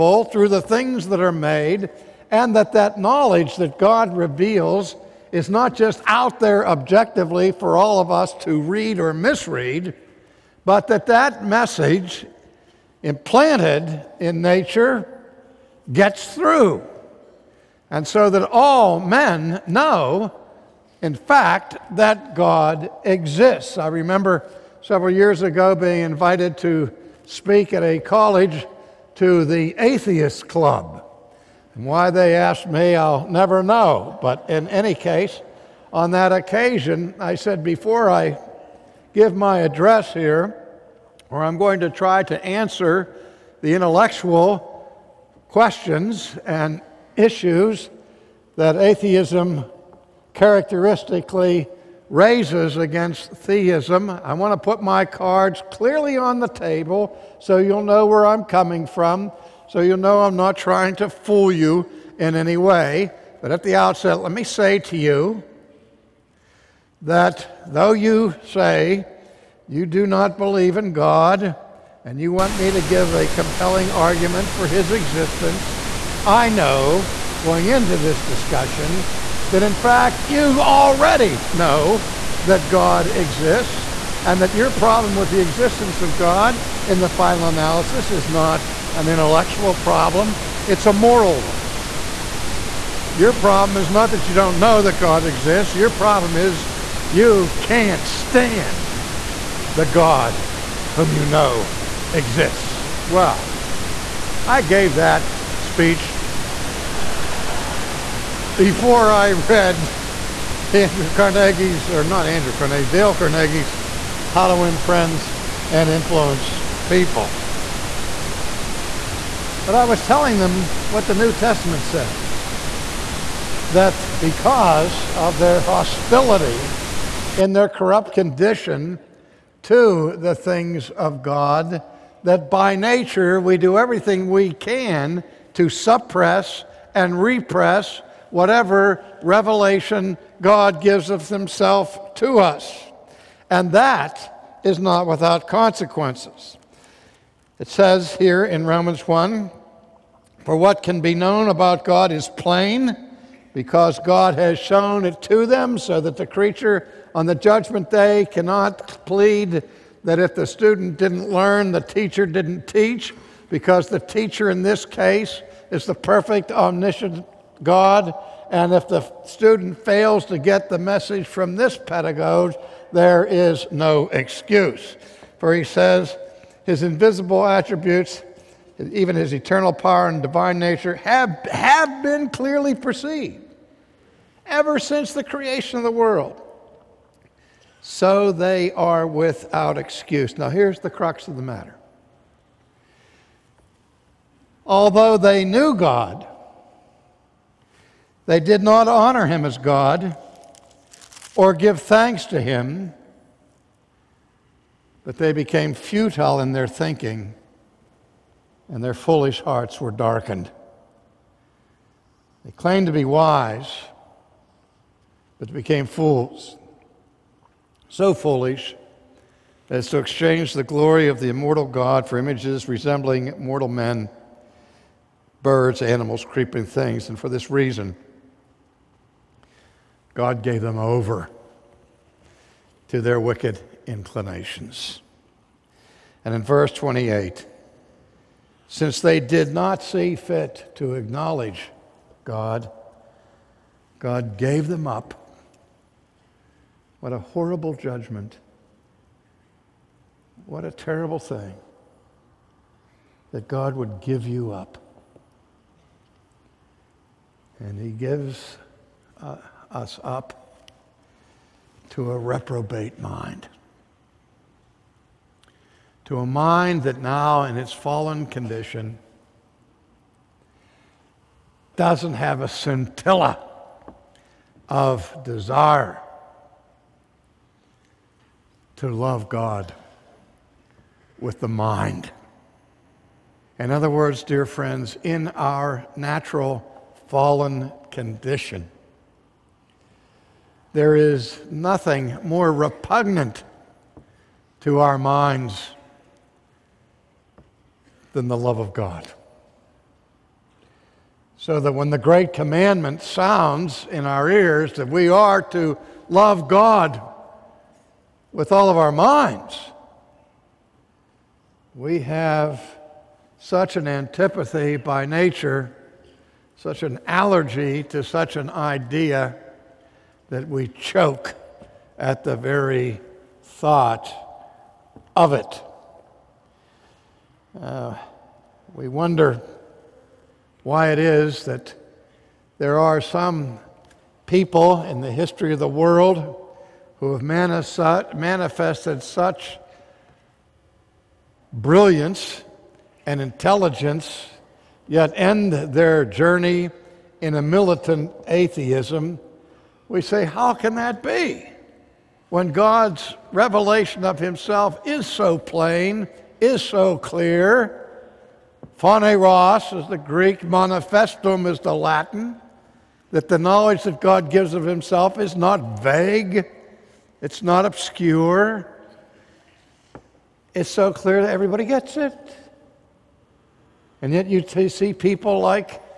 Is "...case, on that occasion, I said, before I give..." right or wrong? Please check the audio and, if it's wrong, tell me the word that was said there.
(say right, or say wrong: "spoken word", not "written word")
right.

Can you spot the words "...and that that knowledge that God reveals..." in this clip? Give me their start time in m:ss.
0:02.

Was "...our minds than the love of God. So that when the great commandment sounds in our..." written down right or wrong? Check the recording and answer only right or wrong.
right.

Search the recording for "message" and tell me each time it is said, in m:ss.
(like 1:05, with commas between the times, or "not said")
0:11, 2:50.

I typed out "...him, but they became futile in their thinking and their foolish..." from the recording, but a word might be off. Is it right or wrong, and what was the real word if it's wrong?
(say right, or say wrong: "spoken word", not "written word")
right.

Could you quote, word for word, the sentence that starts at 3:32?
They claimed to be wise, but became fools.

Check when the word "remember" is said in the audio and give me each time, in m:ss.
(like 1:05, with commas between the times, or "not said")
0:23.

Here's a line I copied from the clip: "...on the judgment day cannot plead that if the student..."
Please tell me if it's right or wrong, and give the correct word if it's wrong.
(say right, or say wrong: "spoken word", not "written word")
right.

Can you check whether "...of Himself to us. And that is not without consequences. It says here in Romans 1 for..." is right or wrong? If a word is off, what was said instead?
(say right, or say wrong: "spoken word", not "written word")
right.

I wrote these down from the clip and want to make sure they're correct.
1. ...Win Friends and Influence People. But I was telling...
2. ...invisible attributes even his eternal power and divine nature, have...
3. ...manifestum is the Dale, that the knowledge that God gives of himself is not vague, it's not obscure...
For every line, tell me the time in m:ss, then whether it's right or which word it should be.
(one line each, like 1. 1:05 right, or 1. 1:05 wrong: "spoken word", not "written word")
1. 1:54 right
2. 2:56 right
3. 6:00 wrong: "Latin", not "Dale".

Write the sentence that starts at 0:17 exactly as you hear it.
And so that all men know, in fact, that God exists.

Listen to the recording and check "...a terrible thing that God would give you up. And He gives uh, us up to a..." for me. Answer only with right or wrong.
right.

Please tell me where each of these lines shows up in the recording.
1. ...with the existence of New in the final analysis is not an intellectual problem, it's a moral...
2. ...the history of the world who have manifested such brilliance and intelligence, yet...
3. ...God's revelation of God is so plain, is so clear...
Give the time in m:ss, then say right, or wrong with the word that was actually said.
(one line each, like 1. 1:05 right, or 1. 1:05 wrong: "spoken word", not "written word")
1. 1:25 wrong: "God", not "New"
2. 5:35 right
3. 5:52 wrong: "Himself", not "God".